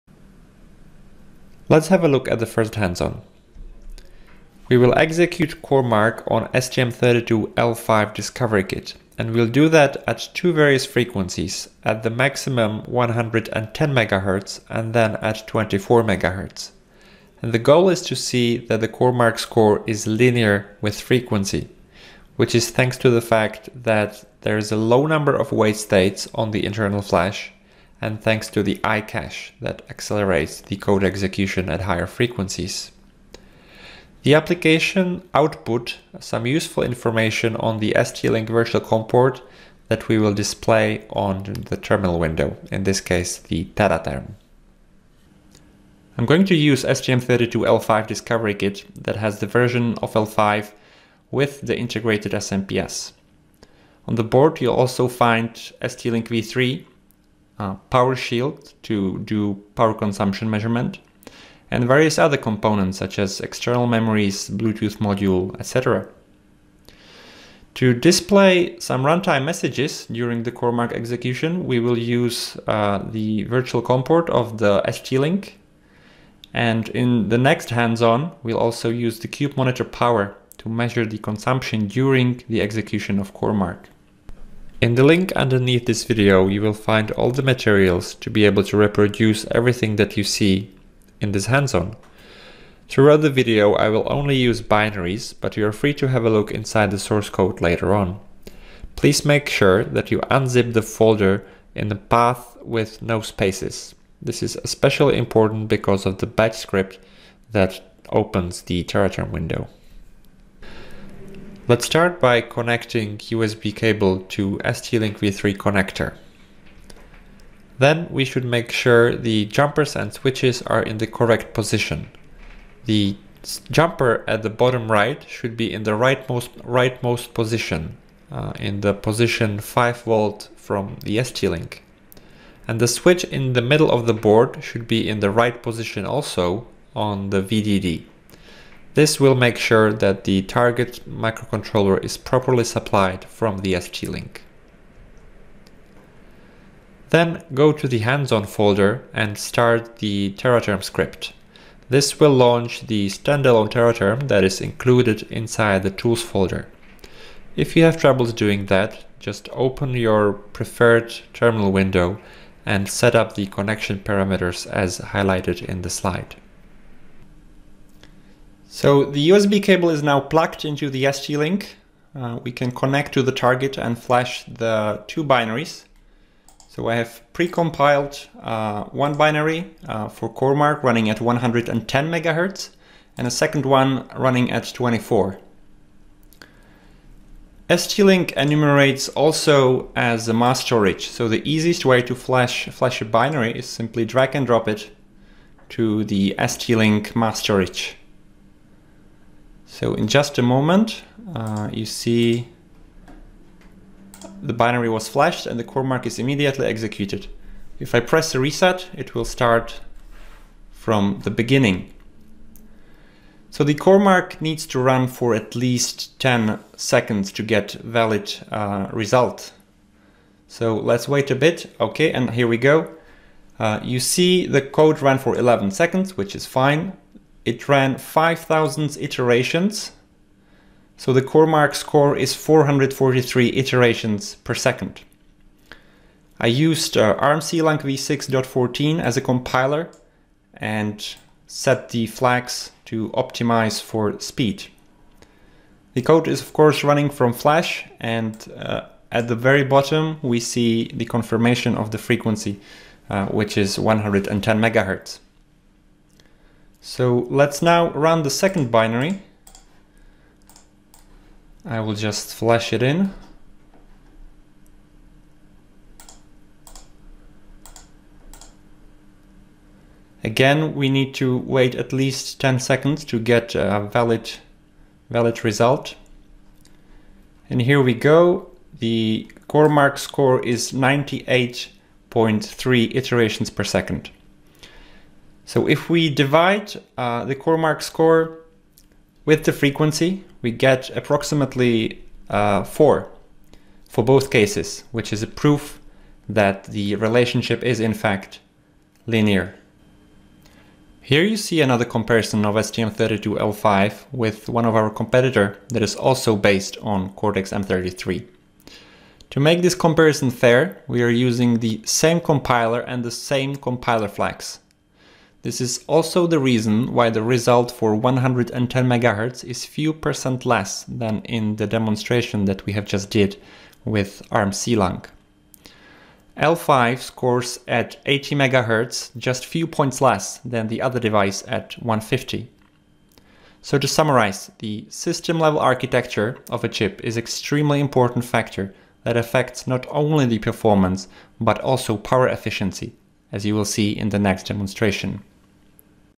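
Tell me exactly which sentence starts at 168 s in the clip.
So the USB cable is now plugged into the ST-Link.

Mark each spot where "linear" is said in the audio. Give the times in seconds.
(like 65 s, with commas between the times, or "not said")
20 s, 299 s.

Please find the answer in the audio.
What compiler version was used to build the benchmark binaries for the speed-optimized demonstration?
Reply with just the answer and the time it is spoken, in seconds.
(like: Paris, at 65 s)
armc v6.14, at 237 s.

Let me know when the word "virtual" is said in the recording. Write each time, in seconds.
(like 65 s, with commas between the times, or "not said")
38 s, 73 s.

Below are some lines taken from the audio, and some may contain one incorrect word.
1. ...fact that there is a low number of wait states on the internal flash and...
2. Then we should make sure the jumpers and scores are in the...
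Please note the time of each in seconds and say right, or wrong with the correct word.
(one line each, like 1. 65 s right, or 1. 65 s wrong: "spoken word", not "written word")
1. 23 s right
2. 117 s wrong: "switches", not "scores".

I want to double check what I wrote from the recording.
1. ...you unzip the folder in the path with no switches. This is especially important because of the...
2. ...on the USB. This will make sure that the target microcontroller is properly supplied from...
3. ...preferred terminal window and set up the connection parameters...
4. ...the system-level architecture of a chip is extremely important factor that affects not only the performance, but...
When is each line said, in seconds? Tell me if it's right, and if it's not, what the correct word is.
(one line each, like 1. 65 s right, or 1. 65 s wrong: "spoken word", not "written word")
1. 100 s wrong: "spaces", not "switches"
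2. 136 s wrong: "VDD", not "USB"
3. 160 s right
4. 334 s right.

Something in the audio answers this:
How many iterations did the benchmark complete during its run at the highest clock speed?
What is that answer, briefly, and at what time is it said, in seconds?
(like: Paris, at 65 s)
5,000, at 227 s.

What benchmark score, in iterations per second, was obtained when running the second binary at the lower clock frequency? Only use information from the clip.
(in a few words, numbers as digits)
98.3.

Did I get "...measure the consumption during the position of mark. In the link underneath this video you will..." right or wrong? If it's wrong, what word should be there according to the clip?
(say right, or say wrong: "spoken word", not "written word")
wrong: "execution", not "position".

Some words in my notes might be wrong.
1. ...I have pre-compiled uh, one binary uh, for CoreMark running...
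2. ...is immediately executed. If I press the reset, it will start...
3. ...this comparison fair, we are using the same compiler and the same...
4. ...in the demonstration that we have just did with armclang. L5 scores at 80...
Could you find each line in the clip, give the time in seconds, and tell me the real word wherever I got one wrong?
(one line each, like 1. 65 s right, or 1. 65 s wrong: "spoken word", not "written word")
1. 176 s right
2. 206 s right
3. 309 s right
4. 321 s right.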